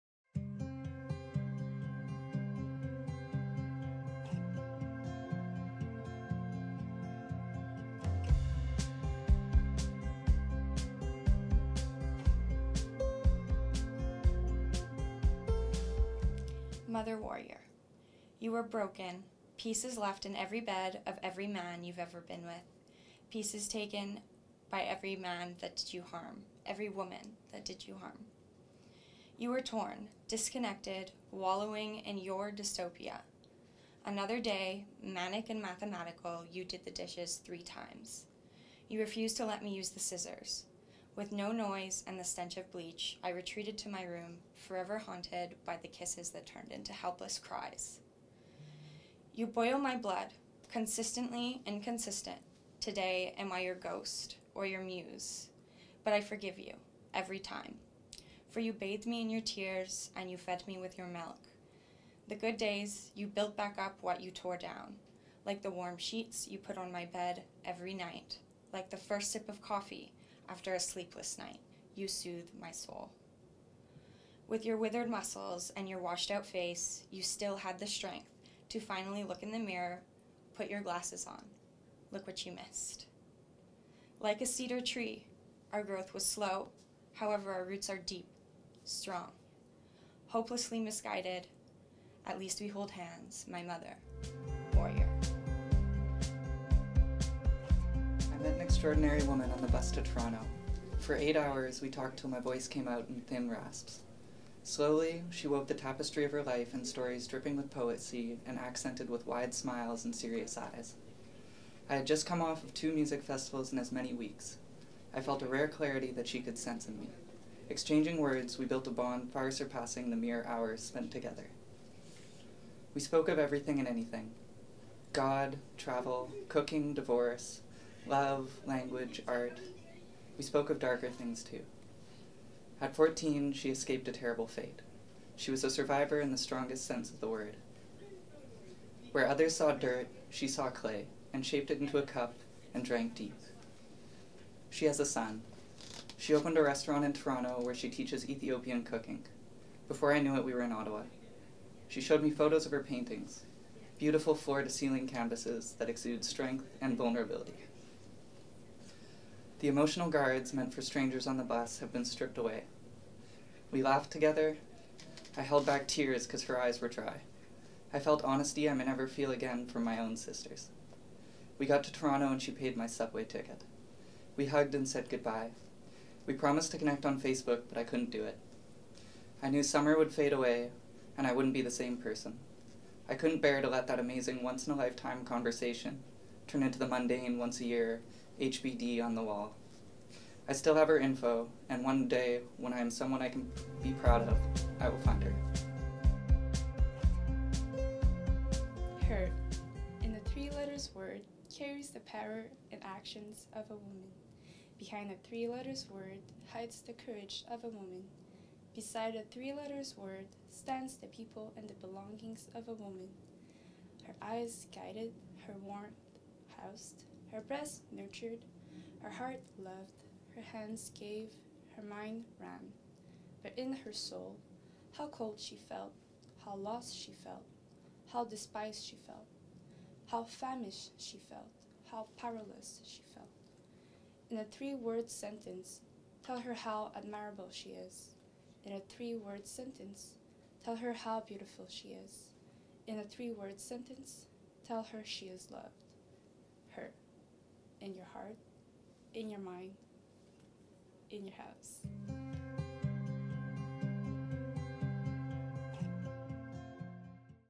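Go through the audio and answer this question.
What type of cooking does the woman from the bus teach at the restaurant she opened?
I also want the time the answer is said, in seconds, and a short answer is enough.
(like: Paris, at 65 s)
Ethiopian, at 148 s.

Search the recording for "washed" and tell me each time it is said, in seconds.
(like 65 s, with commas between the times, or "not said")
75 s.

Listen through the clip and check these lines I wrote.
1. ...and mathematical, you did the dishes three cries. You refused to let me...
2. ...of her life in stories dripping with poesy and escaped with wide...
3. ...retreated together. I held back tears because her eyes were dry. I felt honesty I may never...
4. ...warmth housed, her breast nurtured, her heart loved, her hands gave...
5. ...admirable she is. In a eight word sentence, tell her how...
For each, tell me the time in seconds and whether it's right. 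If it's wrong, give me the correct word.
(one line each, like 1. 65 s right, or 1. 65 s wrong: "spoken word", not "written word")
1. 35 s wrong: "times", not "cries"
2. 106 s wrong: "accented", not "escaped"
3. 163 s wrong: "laughed", not "retreated"
4. 215 s right
5. 236 s wrong: "three", not "eight".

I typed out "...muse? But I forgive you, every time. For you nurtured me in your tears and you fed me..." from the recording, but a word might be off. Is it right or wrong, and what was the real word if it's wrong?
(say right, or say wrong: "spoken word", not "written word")
wrong: "bathed", not "nurtured".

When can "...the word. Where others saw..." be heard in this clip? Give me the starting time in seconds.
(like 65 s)
137 s.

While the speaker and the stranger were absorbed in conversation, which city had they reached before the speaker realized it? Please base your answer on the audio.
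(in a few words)
Ottawa.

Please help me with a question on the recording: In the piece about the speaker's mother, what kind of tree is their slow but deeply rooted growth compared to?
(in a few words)
Cedar.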